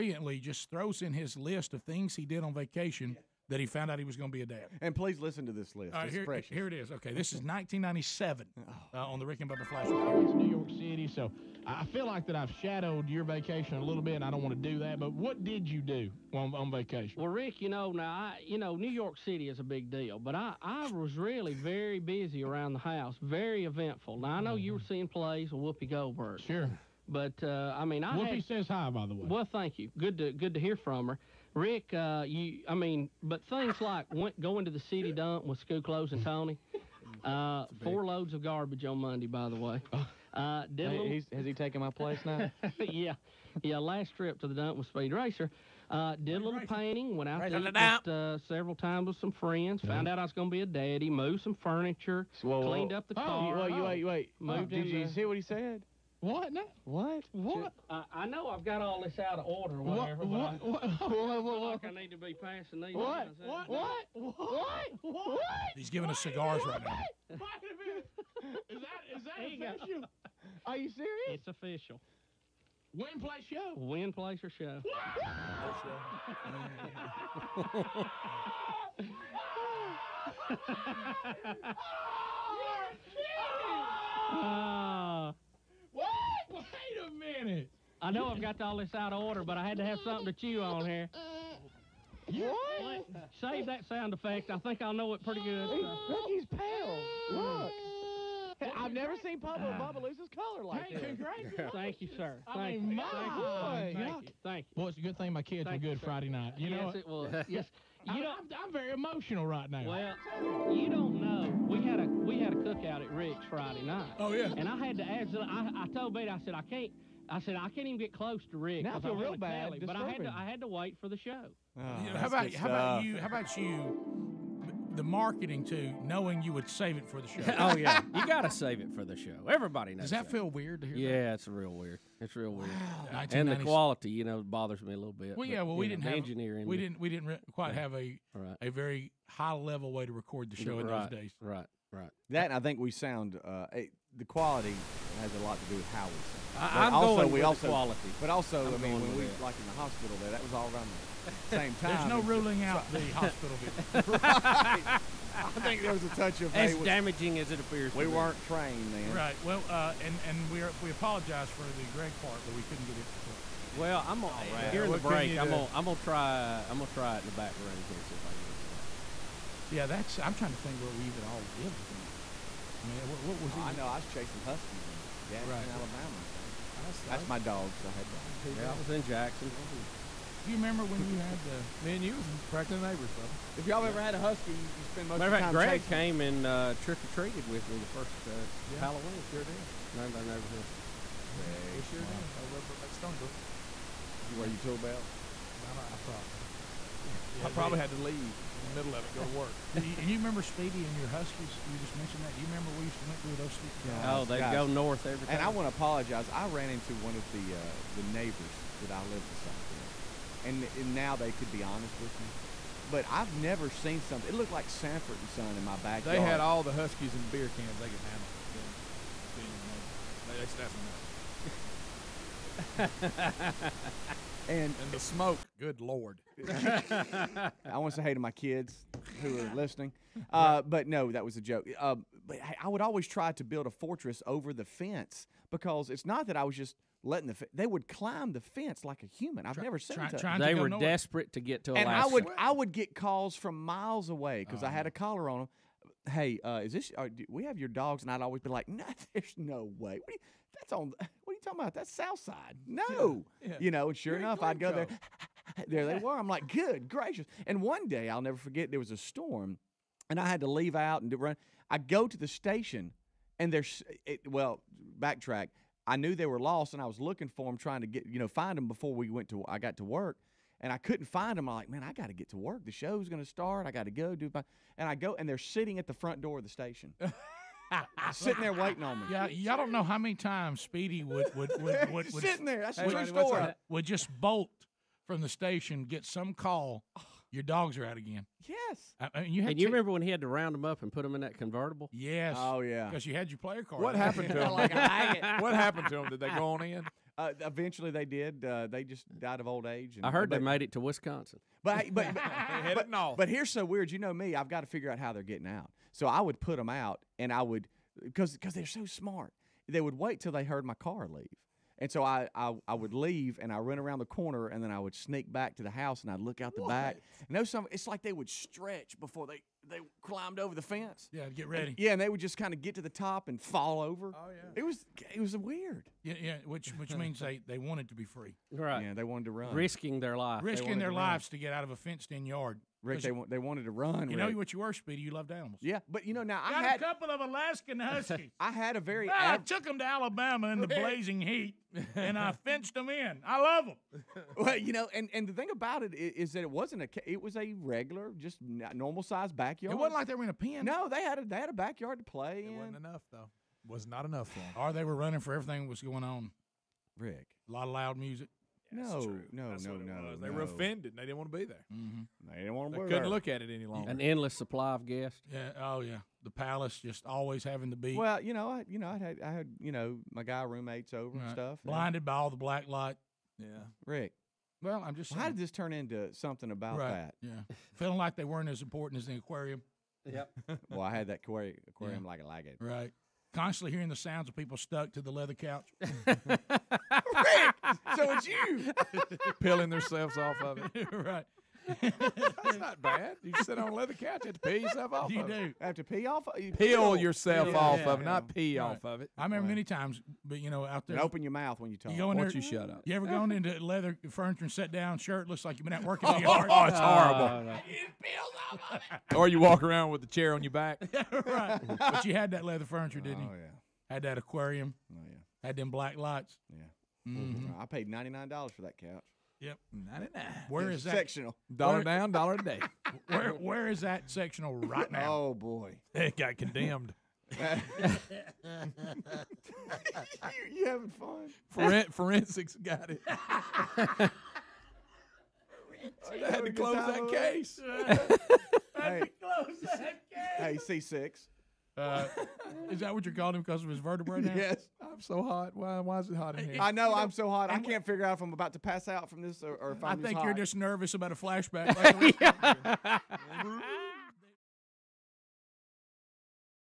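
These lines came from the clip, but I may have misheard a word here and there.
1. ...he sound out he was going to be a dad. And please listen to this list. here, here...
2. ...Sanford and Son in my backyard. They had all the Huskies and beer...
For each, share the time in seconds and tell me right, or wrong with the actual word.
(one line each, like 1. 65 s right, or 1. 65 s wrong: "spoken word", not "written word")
1. 3 s wrong: "found", not "sound"
2. 214 s right.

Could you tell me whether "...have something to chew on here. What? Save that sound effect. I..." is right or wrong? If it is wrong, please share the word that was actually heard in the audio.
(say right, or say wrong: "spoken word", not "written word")
right.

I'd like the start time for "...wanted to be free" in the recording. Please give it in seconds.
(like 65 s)
327 s.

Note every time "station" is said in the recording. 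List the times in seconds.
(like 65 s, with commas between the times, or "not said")
262 s, 276 s, 285 s.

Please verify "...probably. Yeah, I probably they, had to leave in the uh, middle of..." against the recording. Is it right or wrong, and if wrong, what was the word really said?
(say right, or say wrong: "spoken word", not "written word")
right.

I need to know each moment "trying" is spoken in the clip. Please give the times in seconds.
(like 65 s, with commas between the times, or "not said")
170 s, 267 s.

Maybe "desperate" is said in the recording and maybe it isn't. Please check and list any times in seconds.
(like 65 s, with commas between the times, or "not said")
240 s.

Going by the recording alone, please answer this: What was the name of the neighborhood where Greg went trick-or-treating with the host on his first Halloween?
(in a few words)
Stonebrook.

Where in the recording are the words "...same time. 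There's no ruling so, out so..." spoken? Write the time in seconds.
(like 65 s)
151 s.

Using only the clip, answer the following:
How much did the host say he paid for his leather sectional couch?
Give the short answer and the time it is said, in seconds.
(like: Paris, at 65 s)
$99, at 417 s.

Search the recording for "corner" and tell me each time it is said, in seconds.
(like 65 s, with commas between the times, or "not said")
314 s.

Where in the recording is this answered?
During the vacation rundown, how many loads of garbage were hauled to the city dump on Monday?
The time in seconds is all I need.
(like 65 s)
37 s.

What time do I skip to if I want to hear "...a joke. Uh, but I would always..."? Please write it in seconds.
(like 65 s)
231 s.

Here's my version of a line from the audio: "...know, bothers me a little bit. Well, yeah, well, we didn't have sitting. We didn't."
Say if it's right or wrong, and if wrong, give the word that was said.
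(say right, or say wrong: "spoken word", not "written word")
wrong: "engineering", not "sitting".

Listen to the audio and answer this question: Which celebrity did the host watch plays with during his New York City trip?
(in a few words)
Whoopi Goldberg.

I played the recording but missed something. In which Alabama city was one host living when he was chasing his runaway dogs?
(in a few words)
Gadsden.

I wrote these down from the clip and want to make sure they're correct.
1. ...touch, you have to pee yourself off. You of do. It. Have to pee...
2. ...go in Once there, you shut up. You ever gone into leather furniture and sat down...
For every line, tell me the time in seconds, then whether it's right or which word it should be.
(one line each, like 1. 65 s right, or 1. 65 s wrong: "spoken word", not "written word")
1. 393 s wrong: "couch", not "touch"
2. 401 s right.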